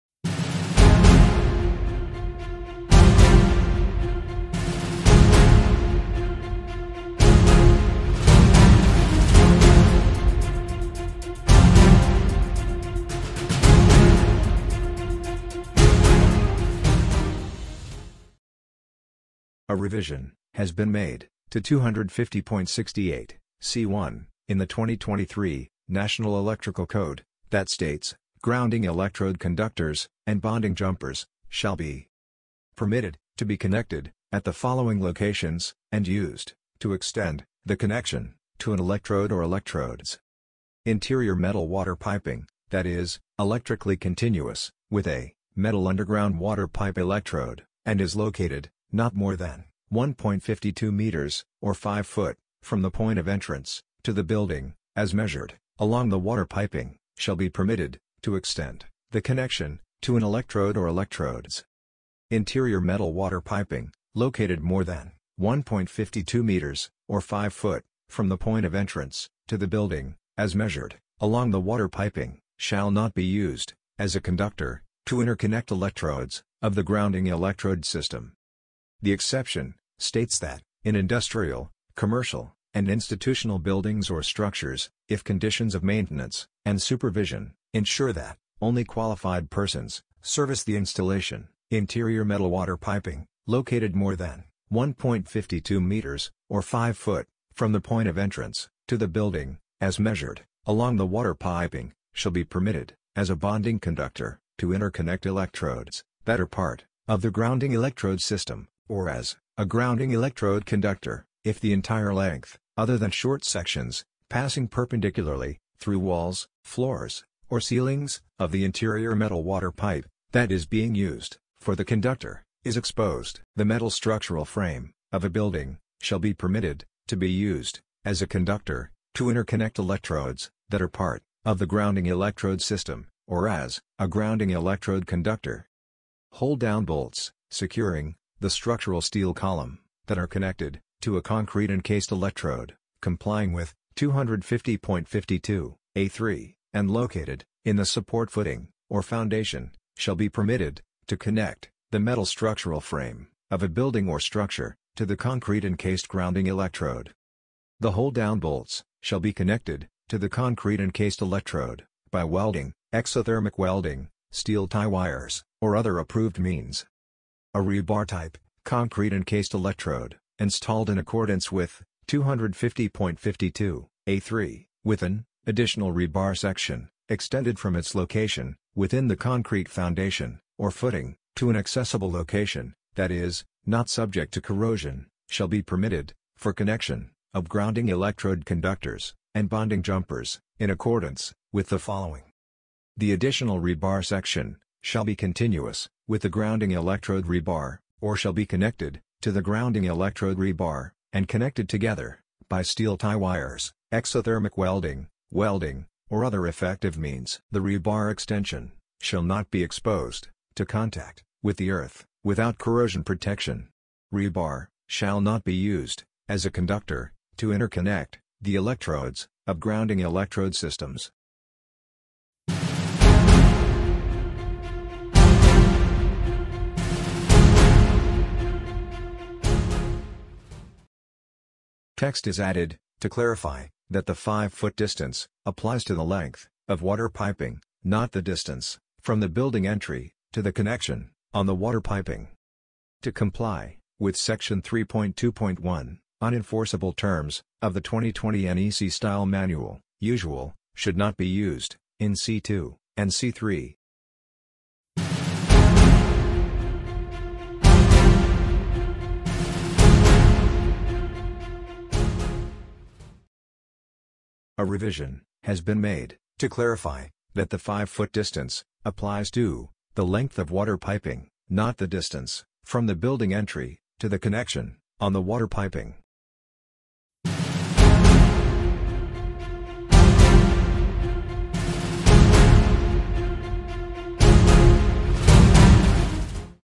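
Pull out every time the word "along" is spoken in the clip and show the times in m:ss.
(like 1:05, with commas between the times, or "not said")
0:55, 1:11, 1:40.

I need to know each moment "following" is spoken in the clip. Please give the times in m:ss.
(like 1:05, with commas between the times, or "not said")
0:34, 3:11.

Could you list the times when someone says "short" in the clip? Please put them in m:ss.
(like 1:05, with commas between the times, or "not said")
1:53.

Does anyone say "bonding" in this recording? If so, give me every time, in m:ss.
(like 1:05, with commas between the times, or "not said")
0:30, 1:43, 3:09.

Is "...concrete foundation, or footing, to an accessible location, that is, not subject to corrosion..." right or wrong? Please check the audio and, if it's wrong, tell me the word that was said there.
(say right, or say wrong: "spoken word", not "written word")
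right.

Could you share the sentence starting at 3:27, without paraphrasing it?
The rebar extension, shall not be exposed, to contact, with the earth, without corrosion protection.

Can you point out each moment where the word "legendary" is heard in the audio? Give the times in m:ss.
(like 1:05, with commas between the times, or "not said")
not said.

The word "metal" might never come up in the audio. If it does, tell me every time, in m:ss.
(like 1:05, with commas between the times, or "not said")
0:41, 0:45, 1:02, 1:32, 1:59, 2:03, 2:31.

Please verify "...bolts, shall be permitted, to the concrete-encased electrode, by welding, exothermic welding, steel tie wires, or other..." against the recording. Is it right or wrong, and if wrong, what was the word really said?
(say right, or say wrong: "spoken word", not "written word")
wrong: "connected", not "permitted".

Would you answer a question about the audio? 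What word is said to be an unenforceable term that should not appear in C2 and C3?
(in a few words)
usual.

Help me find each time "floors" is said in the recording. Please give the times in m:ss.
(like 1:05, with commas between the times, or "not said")
1:56.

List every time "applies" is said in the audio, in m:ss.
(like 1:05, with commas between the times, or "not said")
3:55, 4:28.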